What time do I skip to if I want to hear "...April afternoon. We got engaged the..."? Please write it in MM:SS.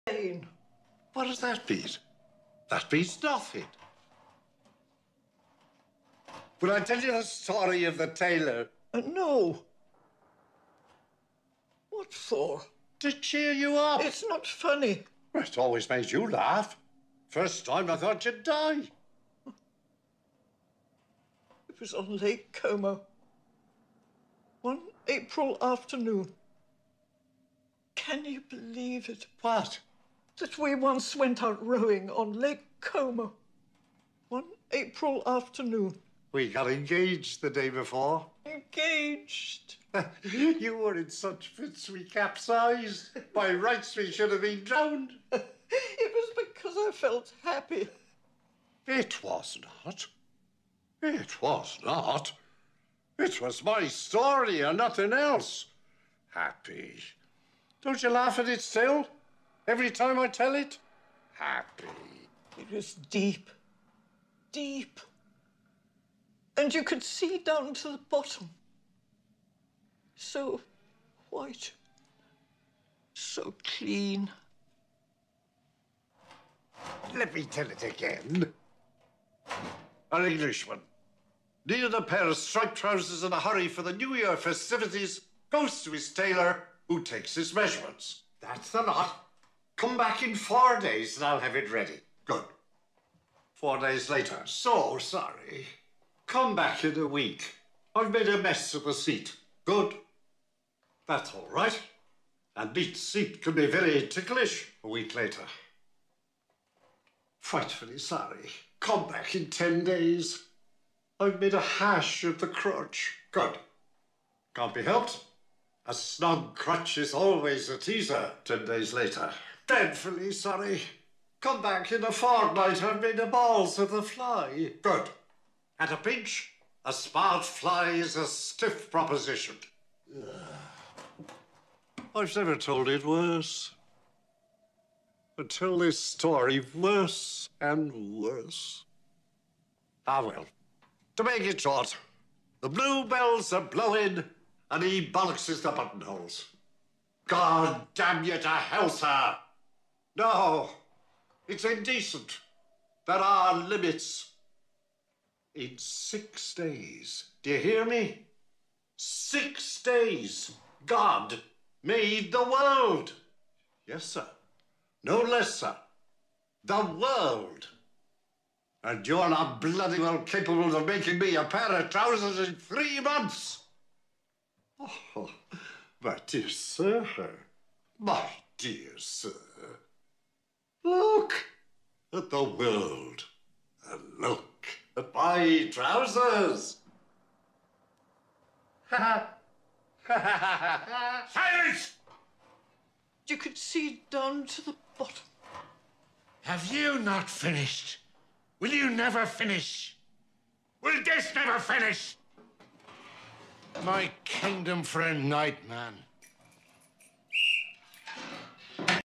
00:34.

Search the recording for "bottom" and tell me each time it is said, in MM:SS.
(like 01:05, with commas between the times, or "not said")
01:08, 03:14.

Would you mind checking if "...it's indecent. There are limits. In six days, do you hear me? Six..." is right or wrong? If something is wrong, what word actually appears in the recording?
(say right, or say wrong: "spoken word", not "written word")
right.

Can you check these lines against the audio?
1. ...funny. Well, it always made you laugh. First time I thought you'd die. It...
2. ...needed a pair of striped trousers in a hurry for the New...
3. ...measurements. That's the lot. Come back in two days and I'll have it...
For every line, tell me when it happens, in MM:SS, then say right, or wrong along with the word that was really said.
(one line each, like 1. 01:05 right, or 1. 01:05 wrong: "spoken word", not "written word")
1. 00:14 right
2. 01:21 right
3. 01:27 wrong: "four", not "two".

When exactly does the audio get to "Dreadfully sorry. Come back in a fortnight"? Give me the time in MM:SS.
01:59.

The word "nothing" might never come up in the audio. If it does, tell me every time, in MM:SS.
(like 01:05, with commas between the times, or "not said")
00:03, 00:54.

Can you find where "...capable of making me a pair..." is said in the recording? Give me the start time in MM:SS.
02:50.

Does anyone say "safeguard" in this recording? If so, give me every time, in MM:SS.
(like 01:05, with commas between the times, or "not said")
not said.